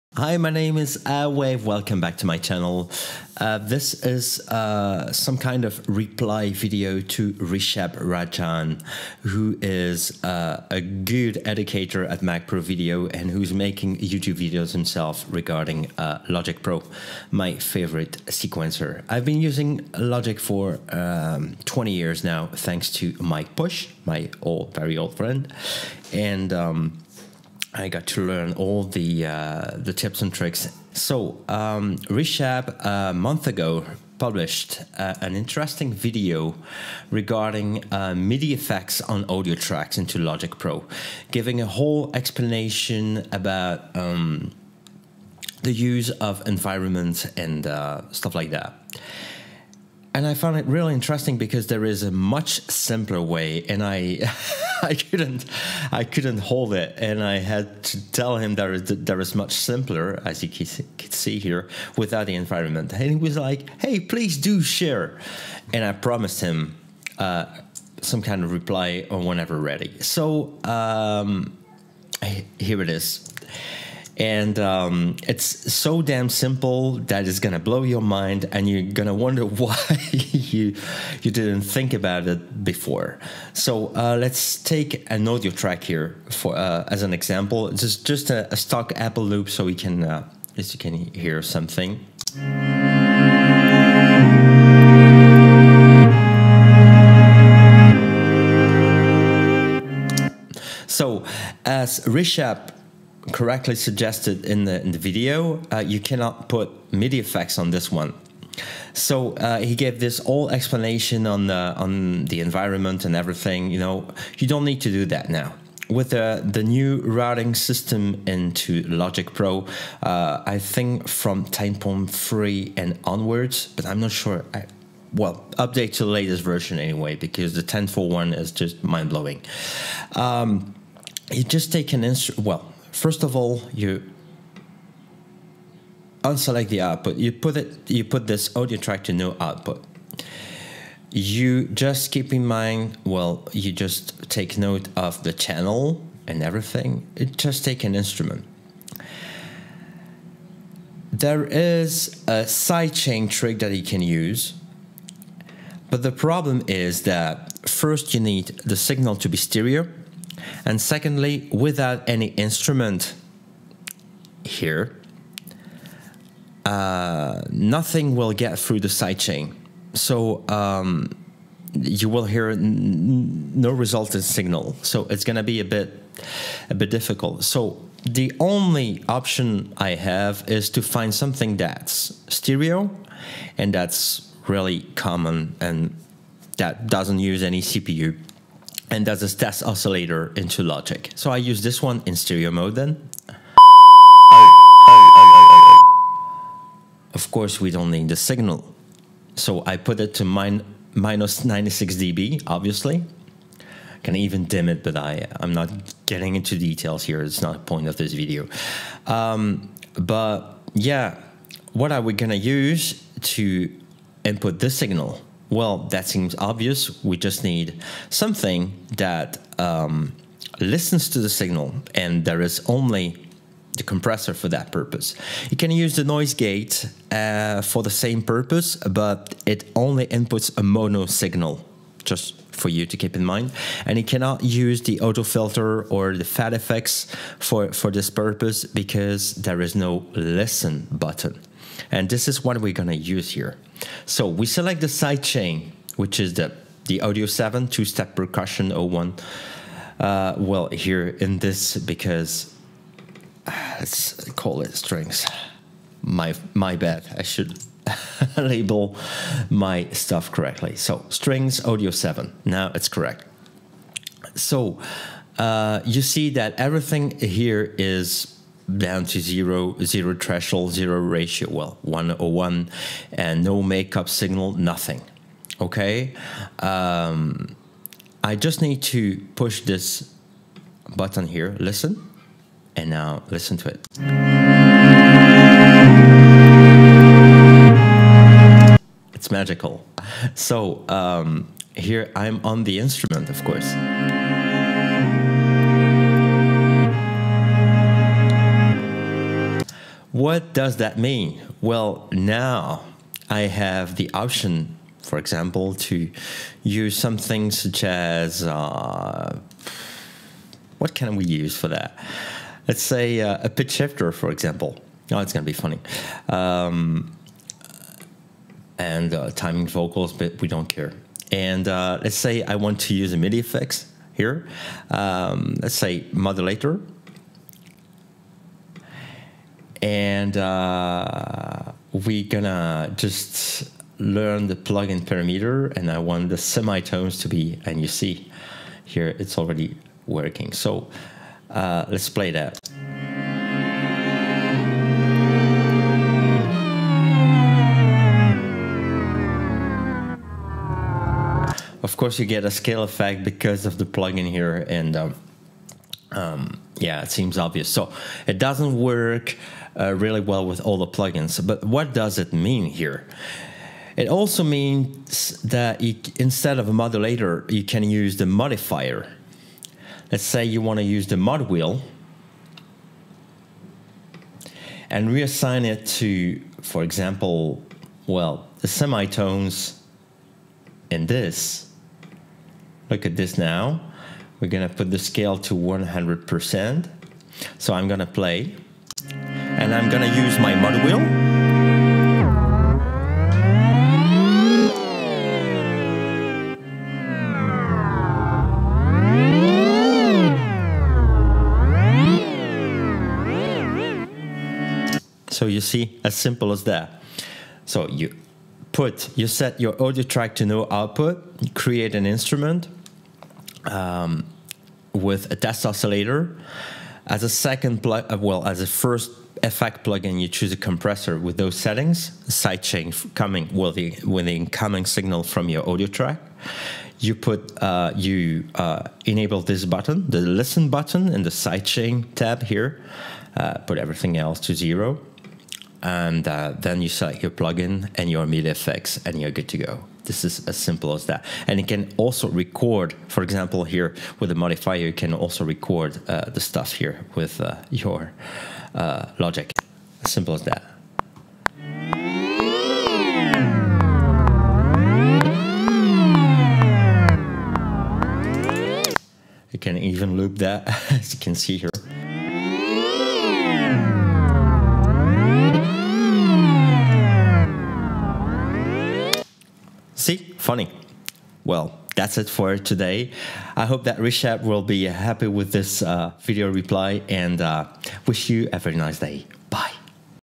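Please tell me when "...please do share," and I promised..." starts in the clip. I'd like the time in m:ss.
1:04.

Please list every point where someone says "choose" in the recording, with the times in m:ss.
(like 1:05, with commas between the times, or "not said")
7:00.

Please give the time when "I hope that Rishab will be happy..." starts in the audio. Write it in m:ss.
7:53.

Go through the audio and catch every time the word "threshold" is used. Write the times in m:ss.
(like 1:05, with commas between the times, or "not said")
4:30.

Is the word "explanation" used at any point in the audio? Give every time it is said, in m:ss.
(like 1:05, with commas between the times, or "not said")
0:42, 1:50.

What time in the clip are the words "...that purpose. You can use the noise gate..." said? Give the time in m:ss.
3:44.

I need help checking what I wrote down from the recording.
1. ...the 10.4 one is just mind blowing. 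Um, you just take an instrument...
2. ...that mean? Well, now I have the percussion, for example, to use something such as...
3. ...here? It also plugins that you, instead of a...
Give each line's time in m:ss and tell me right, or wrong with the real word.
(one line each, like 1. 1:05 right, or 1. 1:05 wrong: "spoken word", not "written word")
1. 2:07 right
2. 5:00 wrong: "option", not "percussion"
3. 6:02 wrong: "means", not "plugins".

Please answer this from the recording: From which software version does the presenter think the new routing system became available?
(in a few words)
10.3.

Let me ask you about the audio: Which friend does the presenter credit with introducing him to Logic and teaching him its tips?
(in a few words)
Mike Bush.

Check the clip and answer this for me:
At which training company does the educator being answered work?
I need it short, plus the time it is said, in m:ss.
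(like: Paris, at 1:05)
Mac Pro Video, at 0:12.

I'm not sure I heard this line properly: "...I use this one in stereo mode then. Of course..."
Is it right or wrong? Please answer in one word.
right.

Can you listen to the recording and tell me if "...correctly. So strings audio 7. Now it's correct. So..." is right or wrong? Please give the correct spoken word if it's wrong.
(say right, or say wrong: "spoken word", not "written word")
right.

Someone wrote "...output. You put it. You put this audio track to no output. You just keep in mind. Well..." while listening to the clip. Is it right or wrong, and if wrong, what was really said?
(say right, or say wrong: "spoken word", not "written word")
right.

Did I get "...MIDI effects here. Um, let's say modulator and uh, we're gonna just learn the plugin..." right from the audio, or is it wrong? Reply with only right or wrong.
right.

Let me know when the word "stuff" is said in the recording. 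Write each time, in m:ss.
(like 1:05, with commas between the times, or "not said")
0:48, 4:19, 7:26.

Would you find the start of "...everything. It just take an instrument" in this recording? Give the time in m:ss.
2:26.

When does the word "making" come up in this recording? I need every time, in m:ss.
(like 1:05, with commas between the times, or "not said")
0:13.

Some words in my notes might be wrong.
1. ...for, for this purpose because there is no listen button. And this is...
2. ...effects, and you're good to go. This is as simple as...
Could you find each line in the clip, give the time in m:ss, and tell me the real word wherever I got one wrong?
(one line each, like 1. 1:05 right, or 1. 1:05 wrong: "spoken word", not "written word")
1. 3:57 right
2. 7:18 right.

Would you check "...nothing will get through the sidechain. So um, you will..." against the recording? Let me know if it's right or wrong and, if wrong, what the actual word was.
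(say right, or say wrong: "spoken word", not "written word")
right.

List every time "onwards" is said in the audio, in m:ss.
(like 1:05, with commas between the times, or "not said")
2:03.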